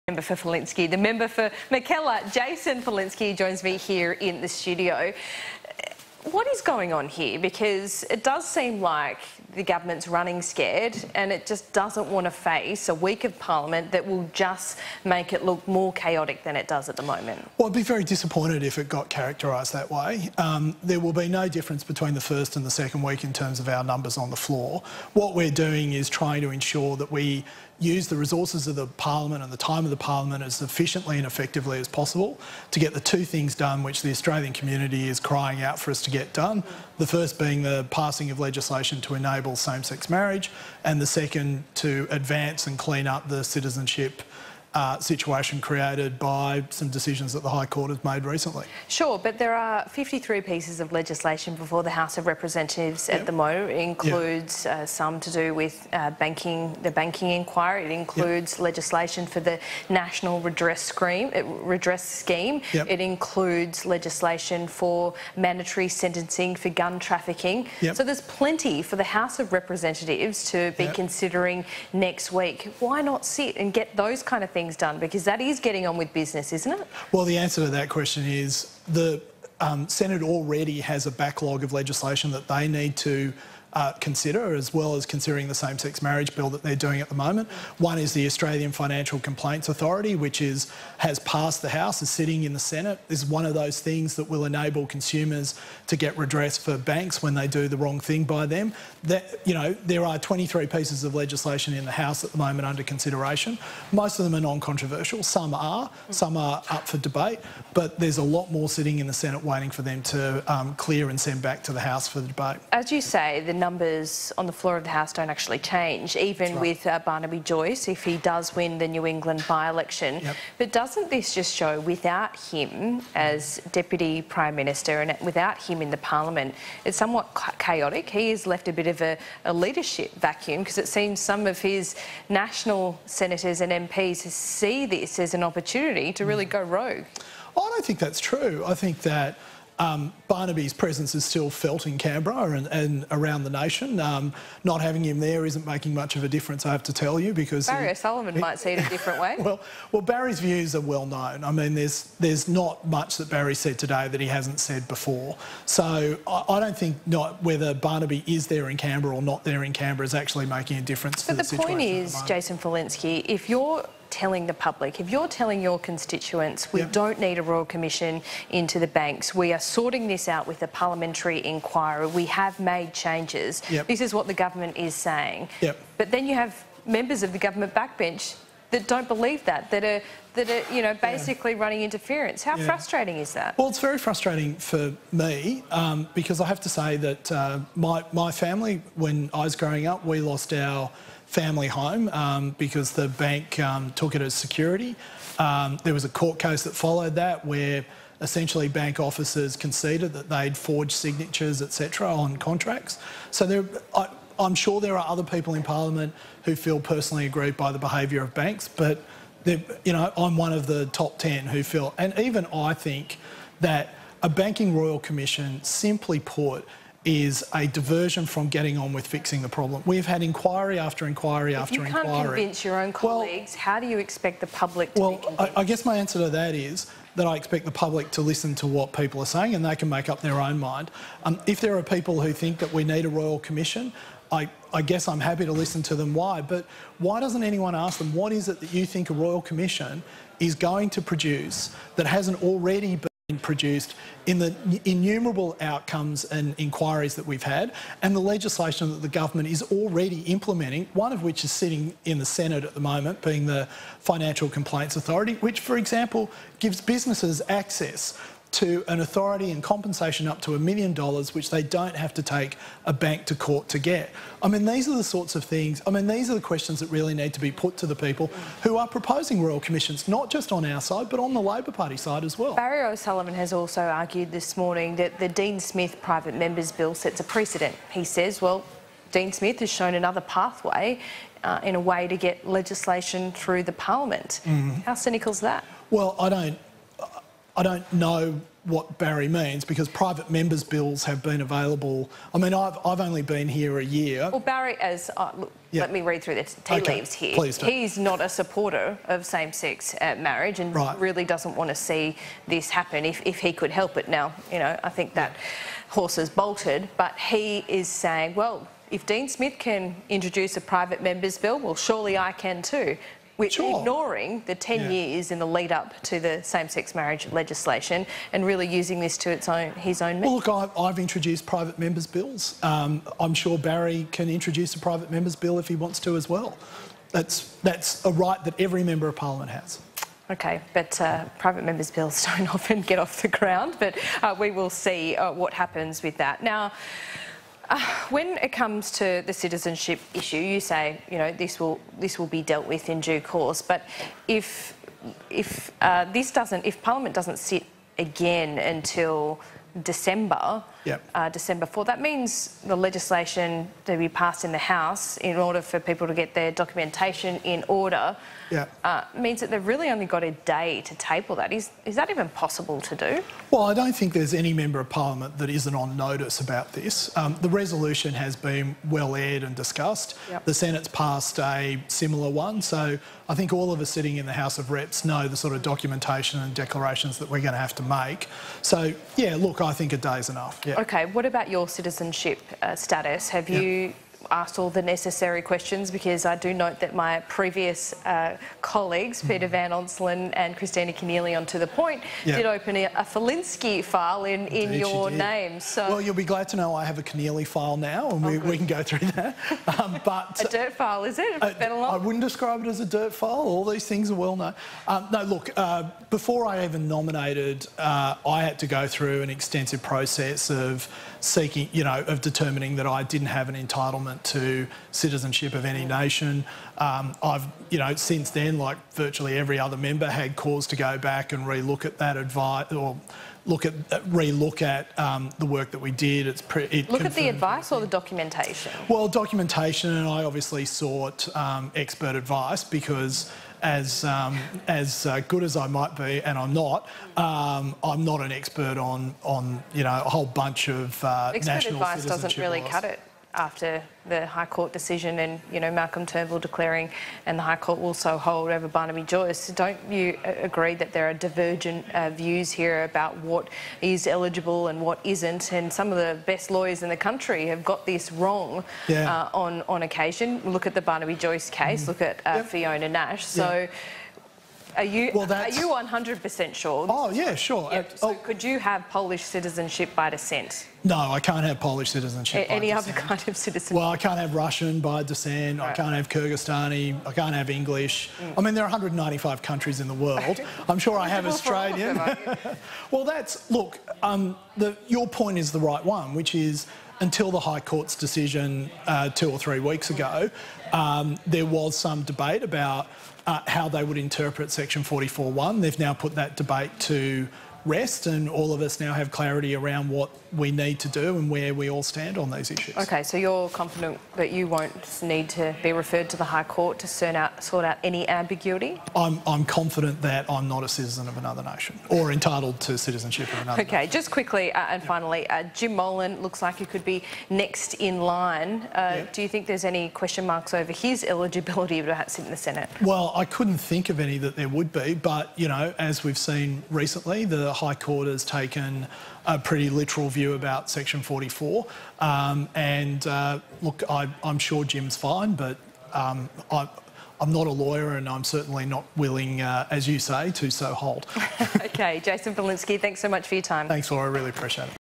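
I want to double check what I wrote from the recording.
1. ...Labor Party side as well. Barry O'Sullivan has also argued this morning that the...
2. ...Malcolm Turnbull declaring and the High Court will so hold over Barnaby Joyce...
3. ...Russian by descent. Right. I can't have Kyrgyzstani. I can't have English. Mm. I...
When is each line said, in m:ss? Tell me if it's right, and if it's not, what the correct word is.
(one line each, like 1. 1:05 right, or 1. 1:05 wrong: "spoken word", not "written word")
1. 4:31 right
2. 7:25 right
3. 7:54 right.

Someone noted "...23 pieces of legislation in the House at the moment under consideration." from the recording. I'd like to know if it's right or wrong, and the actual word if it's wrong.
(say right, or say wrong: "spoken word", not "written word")
right.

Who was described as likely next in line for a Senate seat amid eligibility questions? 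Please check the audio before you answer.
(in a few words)
Jim Molan.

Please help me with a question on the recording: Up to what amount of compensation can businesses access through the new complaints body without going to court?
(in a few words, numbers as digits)
a million dollars.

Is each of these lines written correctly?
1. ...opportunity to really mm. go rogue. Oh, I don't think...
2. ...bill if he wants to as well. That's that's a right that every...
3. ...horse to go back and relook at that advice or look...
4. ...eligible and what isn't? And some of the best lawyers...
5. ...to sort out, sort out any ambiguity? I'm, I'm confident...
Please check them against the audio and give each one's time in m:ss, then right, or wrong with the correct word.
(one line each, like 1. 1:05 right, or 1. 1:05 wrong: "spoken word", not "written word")
1. 2:15 right
2. 5:25 right
3. 7:00 wrong: "cause", not "horse"
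4. 7:34 right
5. 8:26 right.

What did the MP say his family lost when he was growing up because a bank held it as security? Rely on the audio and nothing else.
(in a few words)
family home.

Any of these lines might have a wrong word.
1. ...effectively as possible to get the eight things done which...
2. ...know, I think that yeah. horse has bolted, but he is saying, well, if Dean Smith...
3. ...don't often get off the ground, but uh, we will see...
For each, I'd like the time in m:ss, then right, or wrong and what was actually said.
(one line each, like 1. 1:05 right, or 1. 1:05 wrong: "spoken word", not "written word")
1. 0:31 wrong: "two", not "eight"
2. 5:04 right
3. 5:32 right.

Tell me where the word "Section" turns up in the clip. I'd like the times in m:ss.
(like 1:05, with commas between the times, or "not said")
8:14, 8:50.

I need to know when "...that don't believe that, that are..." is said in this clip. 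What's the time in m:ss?
2:58.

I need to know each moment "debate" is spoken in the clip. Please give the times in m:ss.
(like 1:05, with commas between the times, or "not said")
1:46, 1:52, 8:12, 8:16.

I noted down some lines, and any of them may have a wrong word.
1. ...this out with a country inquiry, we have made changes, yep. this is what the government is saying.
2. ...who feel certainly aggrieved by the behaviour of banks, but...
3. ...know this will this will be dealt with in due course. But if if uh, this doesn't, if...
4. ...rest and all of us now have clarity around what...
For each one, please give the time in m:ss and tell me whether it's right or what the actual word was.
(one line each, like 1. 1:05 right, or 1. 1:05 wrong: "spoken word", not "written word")
1. 2:50 wrong: "parliamentary", not "country"
2. 3:26 wrong: "personally", not "certainly"
3. 5:41 right
4. 8:17 right.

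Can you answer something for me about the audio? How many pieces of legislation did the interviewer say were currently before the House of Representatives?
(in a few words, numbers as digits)
53.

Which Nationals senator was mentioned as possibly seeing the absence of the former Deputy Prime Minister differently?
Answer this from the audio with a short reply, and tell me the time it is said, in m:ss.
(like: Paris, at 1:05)
Barry O'Sullivan, at 2:27.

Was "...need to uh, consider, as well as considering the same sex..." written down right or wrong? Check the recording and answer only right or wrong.
right.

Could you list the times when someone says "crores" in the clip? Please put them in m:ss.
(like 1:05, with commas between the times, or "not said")
not said.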